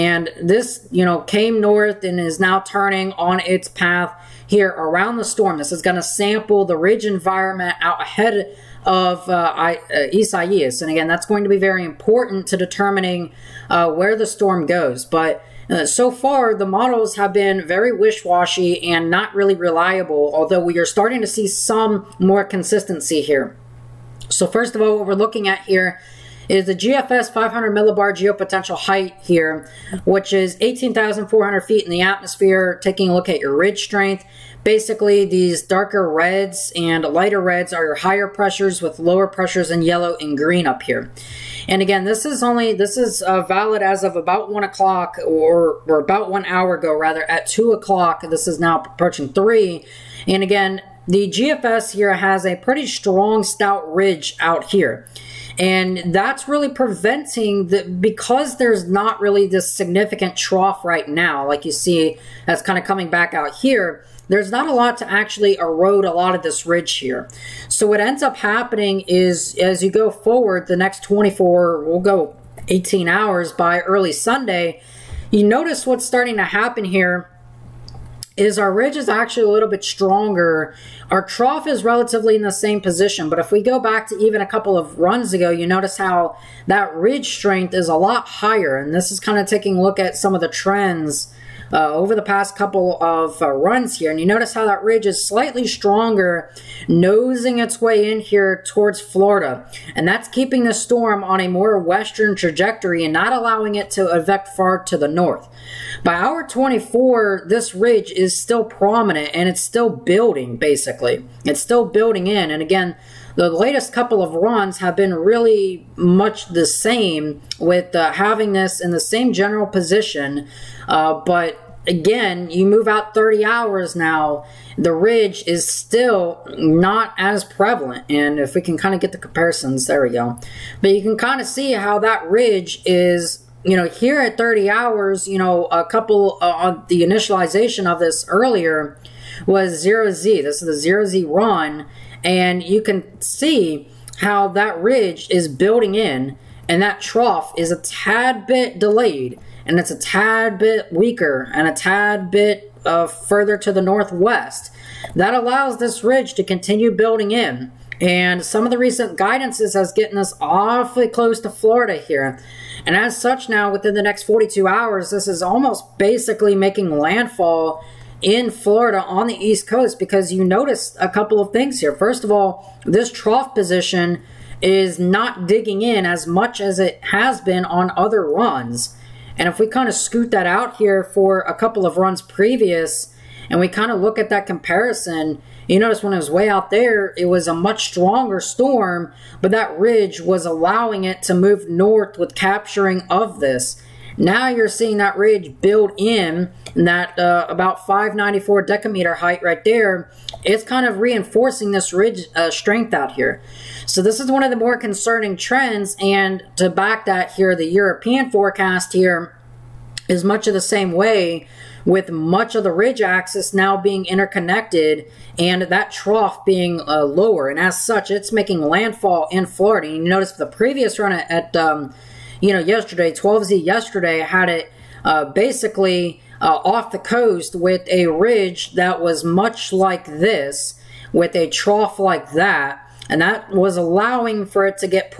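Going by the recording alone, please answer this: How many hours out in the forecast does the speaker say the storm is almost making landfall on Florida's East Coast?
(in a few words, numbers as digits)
42 hours.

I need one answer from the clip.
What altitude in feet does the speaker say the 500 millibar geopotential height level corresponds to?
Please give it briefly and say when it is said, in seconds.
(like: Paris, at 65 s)
18,400 feet, at 30 s.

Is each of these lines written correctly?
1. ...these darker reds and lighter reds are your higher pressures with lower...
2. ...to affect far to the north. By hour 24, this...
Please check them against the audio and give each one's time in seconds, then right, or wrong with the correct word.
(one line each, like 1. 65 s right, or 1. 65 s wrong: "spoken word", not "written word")
1. 35 s right
2. 103 s right.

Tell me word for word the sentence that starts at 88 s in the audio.
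And this is kind of taking a look at some of the trends uh, over the past couple of uh, runs here.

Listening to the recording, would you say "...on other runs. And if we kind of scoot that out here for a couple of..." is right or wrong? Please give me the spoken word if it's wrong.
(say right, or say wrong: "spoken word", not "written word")
right.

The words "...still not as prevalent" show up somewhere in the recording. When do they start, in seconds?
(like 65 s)
125 s.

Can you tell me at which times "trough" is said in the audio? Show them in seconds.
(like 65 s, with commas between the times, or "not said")
60 s, 81 s, 147 s, 173 s, 215 s, 231 s.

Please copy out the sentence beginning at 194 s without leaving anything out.
Now you're seeing that ridge build in that uh, about 594 decameter height right there.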